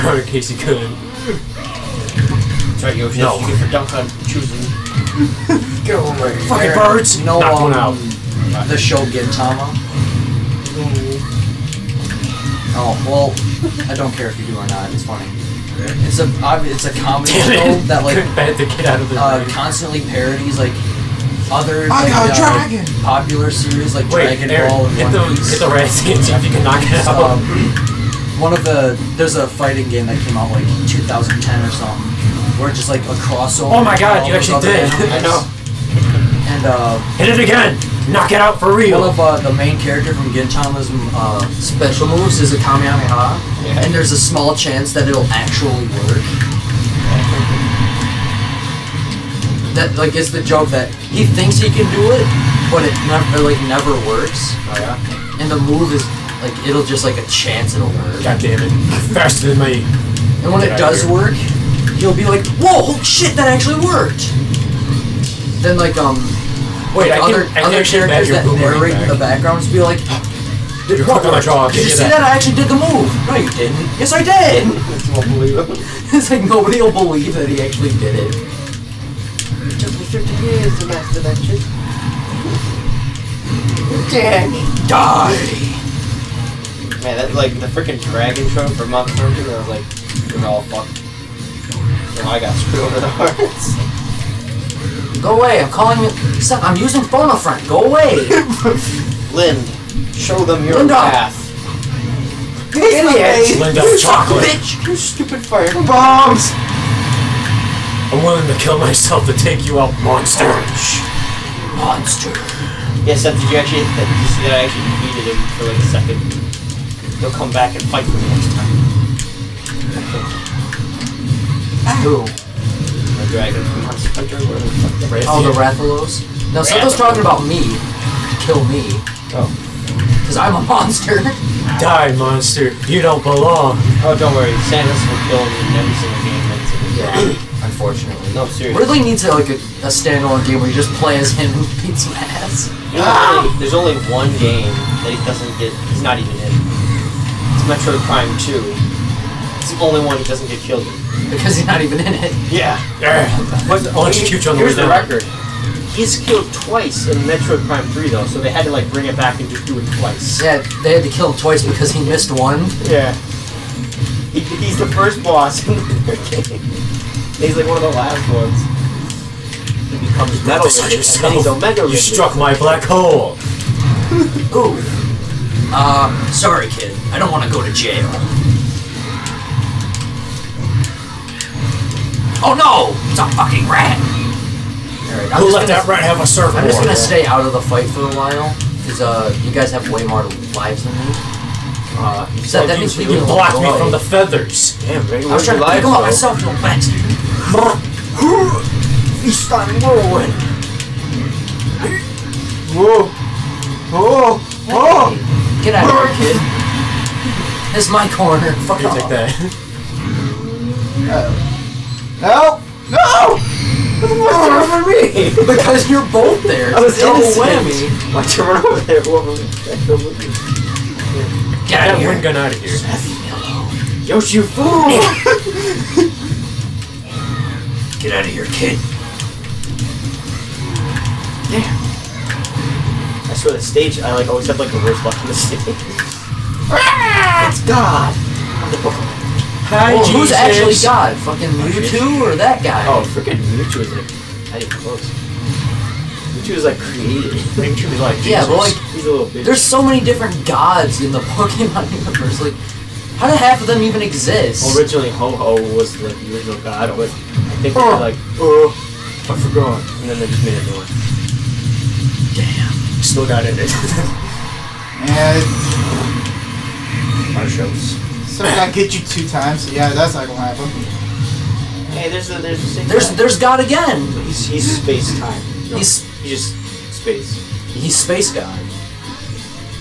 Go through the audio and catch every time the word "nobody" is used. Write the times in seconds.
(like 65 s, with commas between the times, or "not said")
76 s.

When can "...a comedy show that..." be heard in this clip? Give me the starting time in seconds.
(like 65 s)
16 s.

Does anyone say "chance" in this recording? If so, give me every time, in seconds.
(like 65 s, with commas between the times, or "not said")
44 s, 57 s.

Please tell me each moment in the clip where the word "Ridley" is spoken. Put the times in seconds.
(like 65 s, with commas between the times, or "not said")
138 s.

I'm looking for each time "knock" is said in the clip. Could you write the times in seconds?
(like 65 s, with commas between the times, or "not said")
7 s, 26 s, 38 s.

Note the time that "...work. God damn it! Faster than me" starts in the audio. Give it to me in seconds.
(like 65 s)
58 s.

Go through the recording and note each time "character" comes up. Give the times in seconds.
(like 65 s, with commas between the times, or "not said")
39 s, 67 s.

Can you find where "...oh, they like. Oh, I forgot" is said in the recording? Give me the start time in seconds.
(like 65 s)
257 s.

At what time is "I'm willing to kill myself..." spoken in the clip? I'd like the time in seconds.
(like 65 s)
108 s.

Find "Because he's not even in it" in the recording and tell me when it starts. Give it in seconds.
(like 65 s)
151 s.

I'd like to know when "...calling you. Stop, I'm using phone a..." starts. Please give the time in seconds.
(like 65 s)
95 s.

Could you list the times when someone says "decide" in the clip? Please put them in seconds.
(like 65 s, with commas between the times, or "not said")
not said.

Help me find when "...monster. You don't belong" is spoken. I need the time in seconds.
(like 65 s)
132 s.